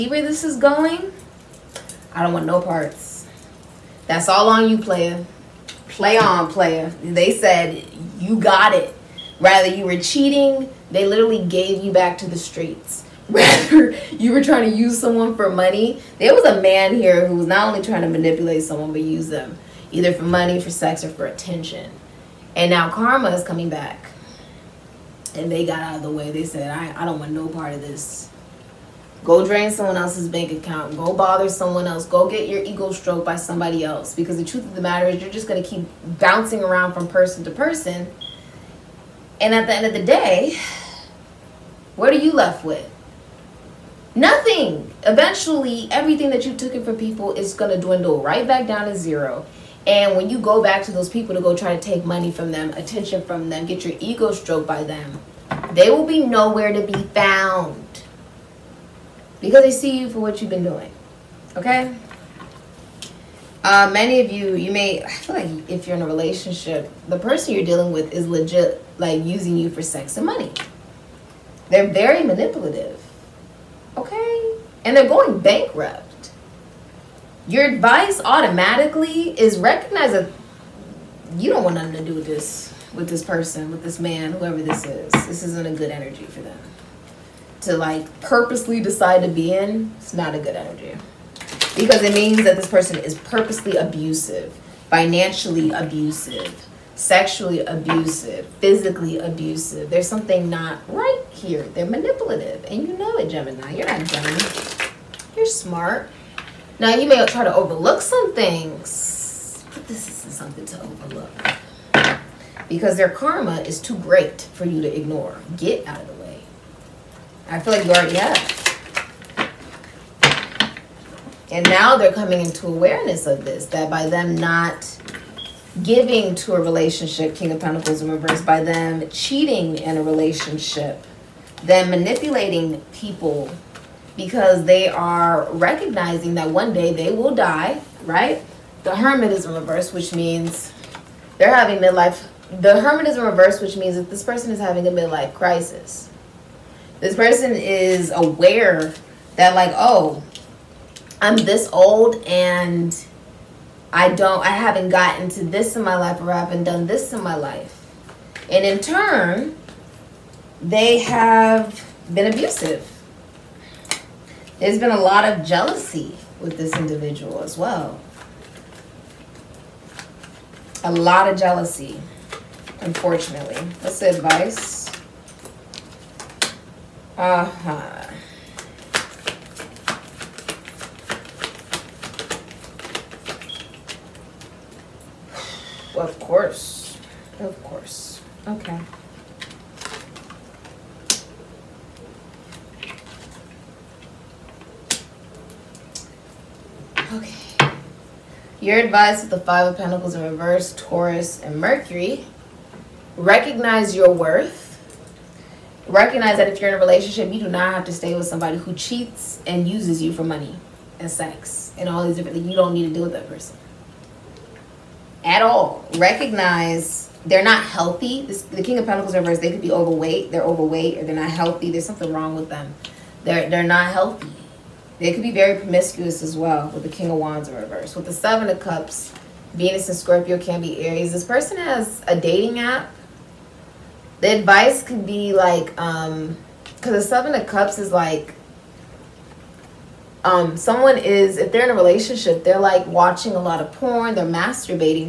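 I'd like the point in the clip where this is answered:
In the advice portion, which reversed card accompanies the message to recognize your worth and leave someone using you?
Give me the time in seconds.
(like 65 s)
199 s.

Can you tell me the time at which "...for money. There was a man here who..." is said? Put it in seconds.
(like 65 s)
15 s.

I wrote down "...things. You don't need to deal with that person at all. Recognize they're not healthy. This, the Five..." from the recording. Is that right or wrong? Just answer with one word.
wrong.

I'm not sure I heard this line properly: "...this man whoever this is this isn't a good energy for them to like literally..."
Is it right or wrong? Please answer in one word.
wrong.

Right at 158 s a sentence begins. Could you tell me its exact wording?
And in turn, they have been abusive there's been a lot of jealousy with this individual as well.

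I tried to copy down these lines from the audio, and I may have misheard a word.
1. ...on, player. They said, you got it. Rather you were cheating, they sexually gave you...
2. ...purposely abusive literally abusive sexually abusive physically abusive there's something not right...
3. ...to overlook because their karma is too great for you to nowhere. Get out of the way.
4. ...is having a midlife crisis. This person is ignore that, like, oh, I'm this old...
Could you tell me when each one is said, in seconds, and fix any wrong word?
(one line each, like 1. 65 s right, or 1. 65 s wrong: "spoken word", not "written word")
1. 6 s wrong: "literally", not "sexually"
2. 93 s wrong: "financially", not "literally"
3. 110 s wrong: "ignore", not "nowhere"
4. 144 s wrong: "aware", not "ignore".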